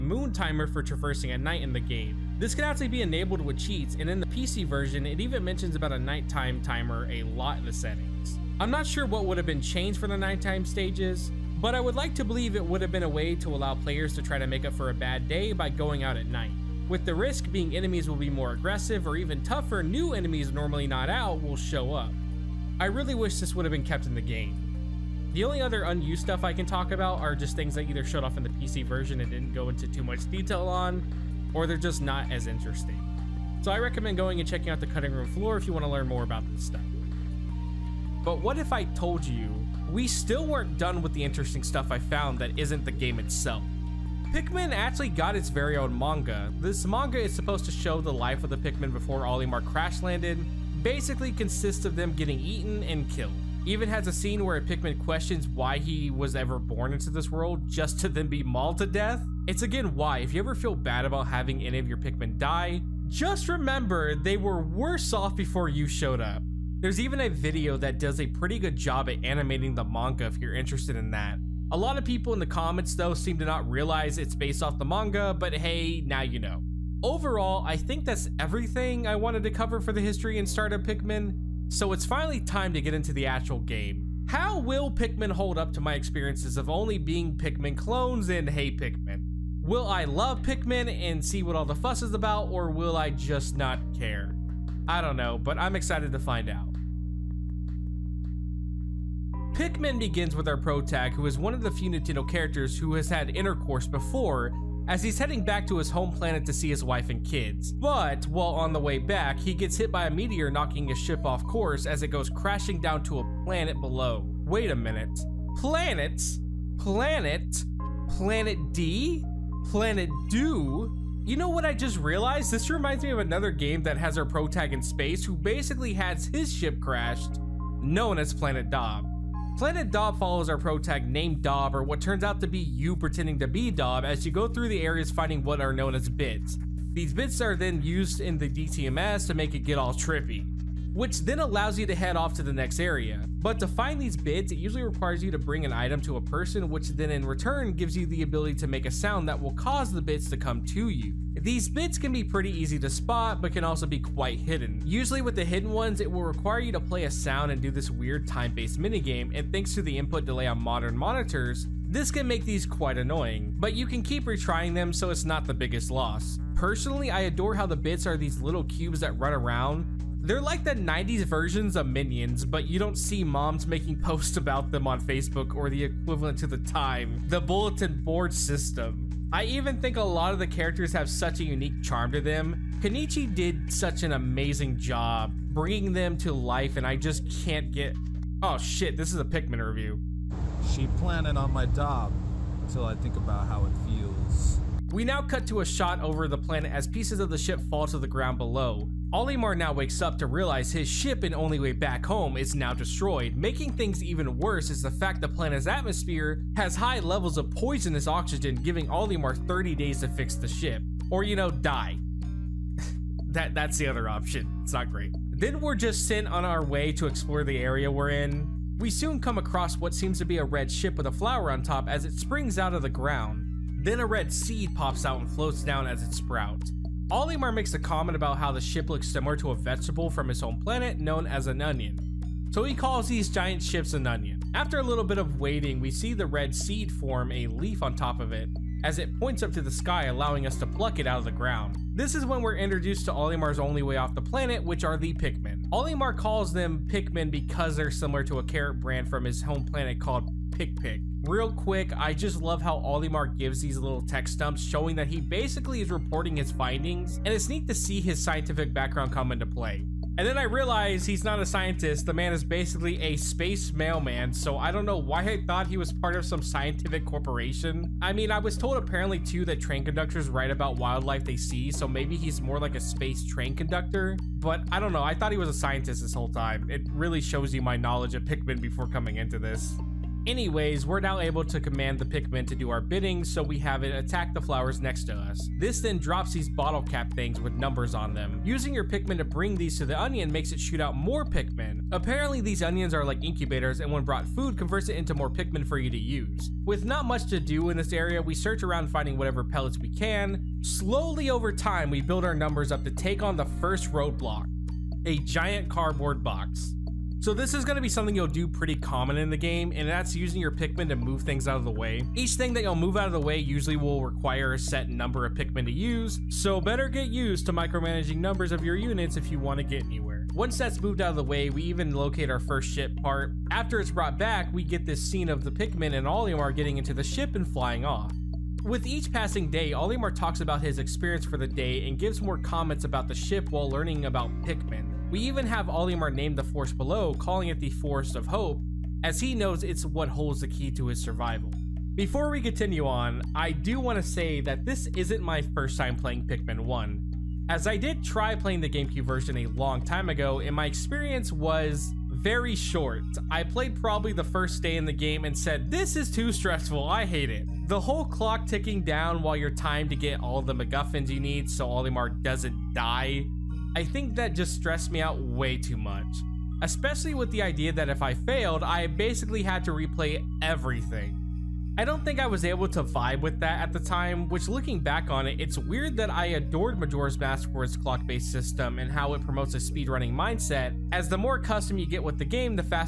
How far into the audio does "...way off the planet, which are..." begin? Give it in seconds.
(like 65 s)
243 s.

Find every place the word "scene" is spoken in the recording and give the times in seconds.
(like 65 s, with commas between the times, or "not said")
54 s, 325 s.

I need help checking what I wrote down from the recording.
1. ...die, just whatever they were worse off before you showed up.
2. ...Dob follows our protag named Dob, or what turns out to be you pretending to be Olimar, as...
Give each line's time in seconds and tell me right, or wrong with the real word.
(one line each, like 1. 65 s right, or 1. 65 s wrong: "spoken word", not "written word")
1. 62 s wrong: "remember", not "whatever"
2. 129 s wrong: "Dob", not "Olimar".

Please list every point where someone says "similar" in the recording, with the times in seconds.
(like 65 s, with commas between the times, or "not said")
229 s, 247 s.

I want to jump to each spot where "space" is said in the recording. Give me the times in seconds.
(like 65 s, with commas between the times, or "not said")
124 s, 263 s, 272 s.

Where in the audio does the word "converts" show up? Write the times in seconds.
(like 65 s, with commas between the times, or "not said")
294 s.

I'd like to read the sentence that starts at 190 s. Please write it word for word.
She planted on my dob until I think about how it feels.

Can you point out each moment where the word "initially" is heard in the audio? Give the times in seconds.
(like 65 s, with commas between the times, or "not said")
not said.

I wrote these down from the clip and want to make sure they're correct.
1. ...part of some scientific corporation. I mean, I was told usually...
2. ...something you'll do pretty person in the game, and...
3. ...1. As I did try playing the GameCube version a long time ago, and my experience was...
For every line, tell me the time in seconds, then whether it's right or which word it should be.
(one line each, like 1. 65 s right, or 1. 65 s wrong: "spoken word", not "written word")
1. 265 s wrong: "apparently", not "usually"
2. 307 s wrong: "common", not "person"
3. 346 s right.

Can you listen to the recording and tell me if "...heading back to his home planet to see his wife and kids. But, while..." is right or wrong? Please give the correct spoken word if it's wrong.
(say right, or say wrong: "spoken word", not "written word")
right.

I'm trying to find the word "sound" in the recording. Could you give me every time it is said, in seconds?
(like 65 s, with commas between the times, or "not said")
148 s, 157 s.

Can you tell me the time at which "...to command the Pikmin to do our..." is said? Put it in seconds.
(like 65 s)
281 s.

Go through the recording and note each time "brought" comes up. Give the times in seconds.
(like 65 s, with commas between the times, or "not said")
294 s, 323 s.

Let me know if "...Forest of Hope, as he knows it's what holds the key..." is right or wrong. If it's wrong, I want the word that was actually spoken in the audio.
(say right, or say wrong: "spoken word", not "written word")
right.